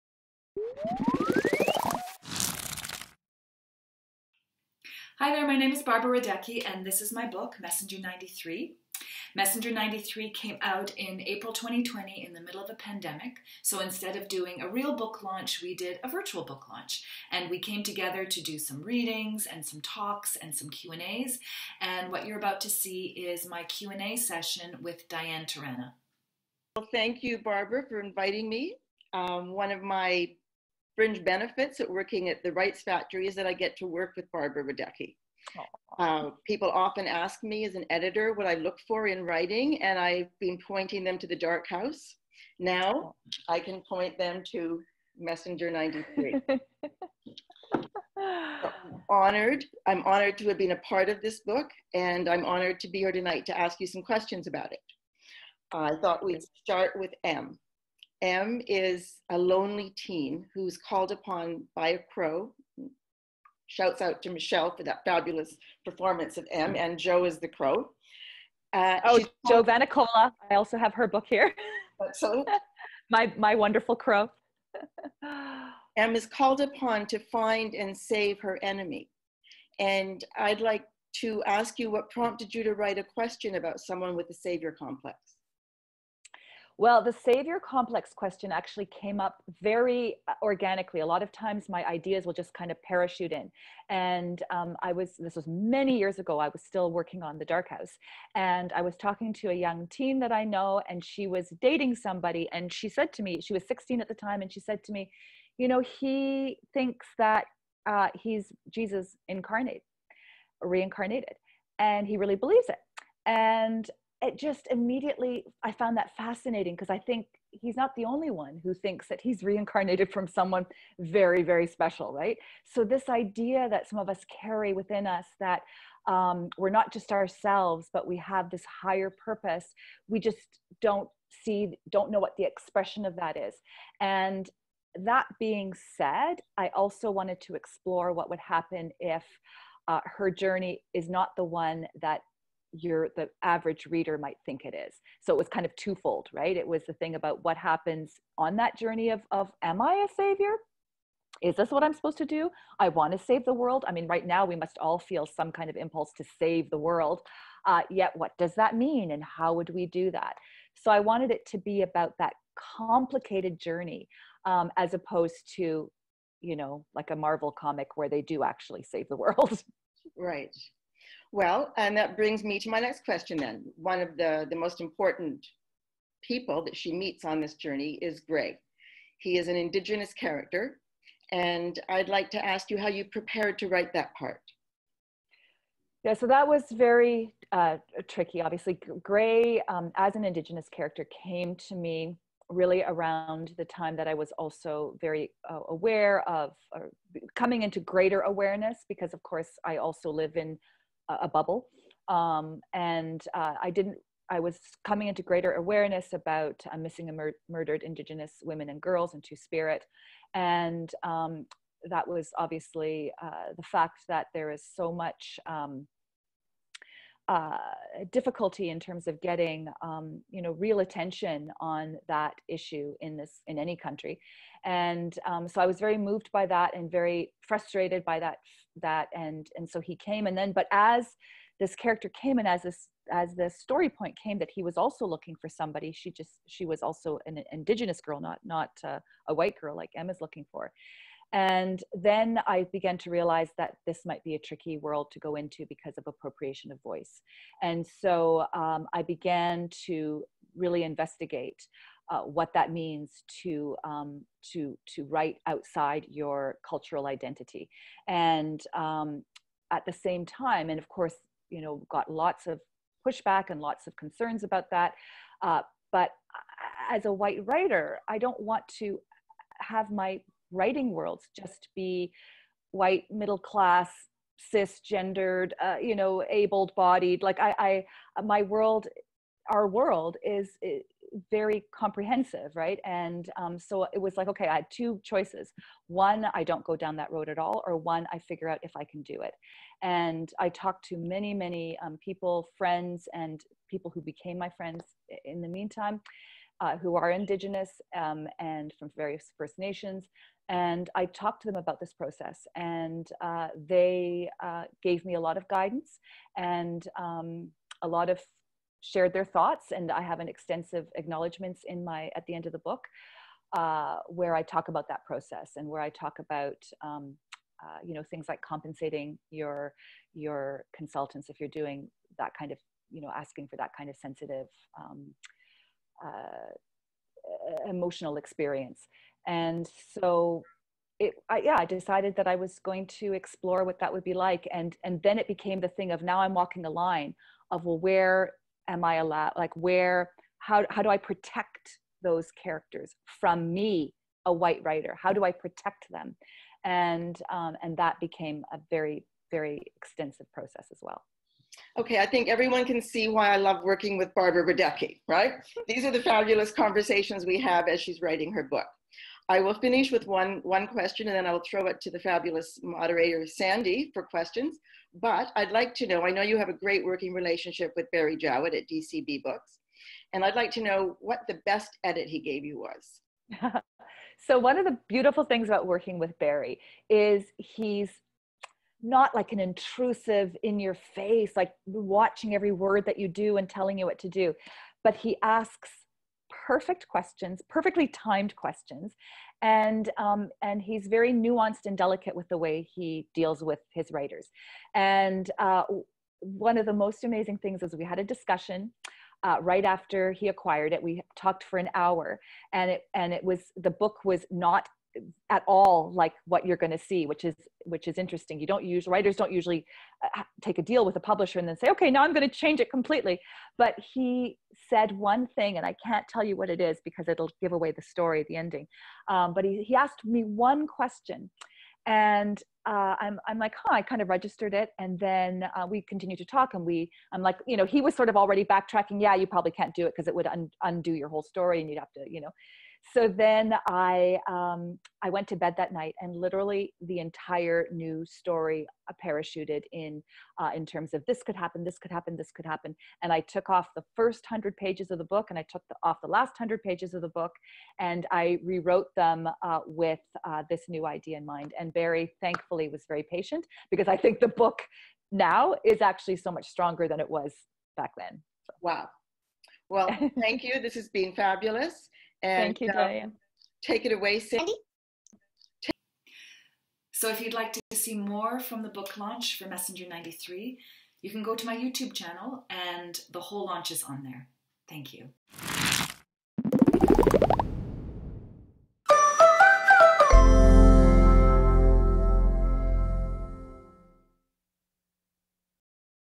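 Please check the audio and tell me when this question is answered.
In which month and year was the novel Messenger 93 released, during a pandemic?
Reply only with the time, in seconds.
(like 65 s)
11 s.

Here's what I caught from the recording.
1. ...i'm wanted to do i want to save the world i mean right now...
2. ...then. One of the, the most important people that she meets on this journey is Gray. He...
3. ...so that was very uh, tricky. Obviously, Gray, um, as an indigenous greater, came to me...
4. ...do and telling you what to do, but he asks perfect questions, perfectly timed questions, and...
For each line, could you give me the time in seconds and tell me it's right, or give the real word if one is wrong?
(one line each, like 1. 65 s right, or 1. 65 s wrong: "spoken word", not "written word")
1. 151 s wrong: "supposed", not "wanted"
2. 173 s right
3. 186 s wrong: "character", not "greater"
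4. 383 s right.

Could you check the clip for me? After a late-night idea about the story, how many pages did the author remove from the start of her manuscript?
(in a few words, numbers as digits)
100.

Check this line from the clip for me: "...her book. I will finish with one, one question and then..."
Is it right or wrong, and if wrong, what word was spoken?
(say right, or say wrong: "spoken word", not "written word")
right.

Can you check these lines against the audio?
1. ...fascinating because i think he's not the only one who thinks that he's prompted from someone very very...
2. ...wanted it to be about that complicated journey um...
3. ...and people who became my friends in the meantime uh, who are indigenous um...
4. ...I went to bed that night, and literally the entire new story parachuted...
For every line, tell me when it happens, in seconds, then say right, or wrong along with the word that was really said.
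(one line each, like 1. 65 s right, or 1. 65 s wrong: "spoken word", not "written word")
1. 116 s wrong: "reincarnated", not "prompted"
2. 160 s right
3. 293 s right
4. 435 s right.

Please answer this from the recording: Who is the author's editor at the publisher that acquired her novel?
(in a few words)
Barry Jowett.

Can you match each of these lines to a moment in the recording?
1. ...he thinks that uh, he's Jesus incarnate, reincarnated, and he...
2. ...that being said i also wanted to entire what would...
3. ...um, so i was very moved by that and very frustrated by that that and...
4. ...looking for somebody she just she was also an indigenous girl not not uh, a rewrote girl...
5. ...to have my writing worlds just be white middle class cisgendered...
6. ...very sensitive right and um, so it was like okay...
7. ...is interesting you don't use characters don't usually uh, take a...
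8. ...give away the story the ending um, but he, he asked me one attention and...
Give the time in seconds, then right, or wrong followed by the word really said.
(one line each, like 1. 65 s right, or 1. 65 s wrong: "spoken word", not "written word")
1. 105 s right
2. 134 s wrong: "explore", not "entire"
3. 225 s right
4. 235 s wrong: "white", not "rewrote"
5. 268 s right
6. 281 s wrong: "comprehensive", not "sensitive"
7. 407 s wrong: "writers", not "characters"
8. 417 s wrong: "question", not "attention".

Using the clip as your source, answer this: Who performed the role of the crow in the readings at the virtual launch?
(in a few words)
Joe Vanicola.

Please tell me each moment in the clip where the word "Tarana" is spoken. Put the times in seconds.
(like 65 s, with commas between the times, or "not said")
25 s.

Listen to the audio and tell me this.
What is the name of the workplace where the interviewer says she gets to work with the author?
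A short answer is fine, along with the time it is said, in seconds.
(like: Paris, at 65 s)
the Wrights Factory, at 32 s.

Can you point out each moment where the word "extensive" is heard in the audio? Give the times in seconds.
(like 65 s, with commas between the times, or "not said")
310 s, 349 s.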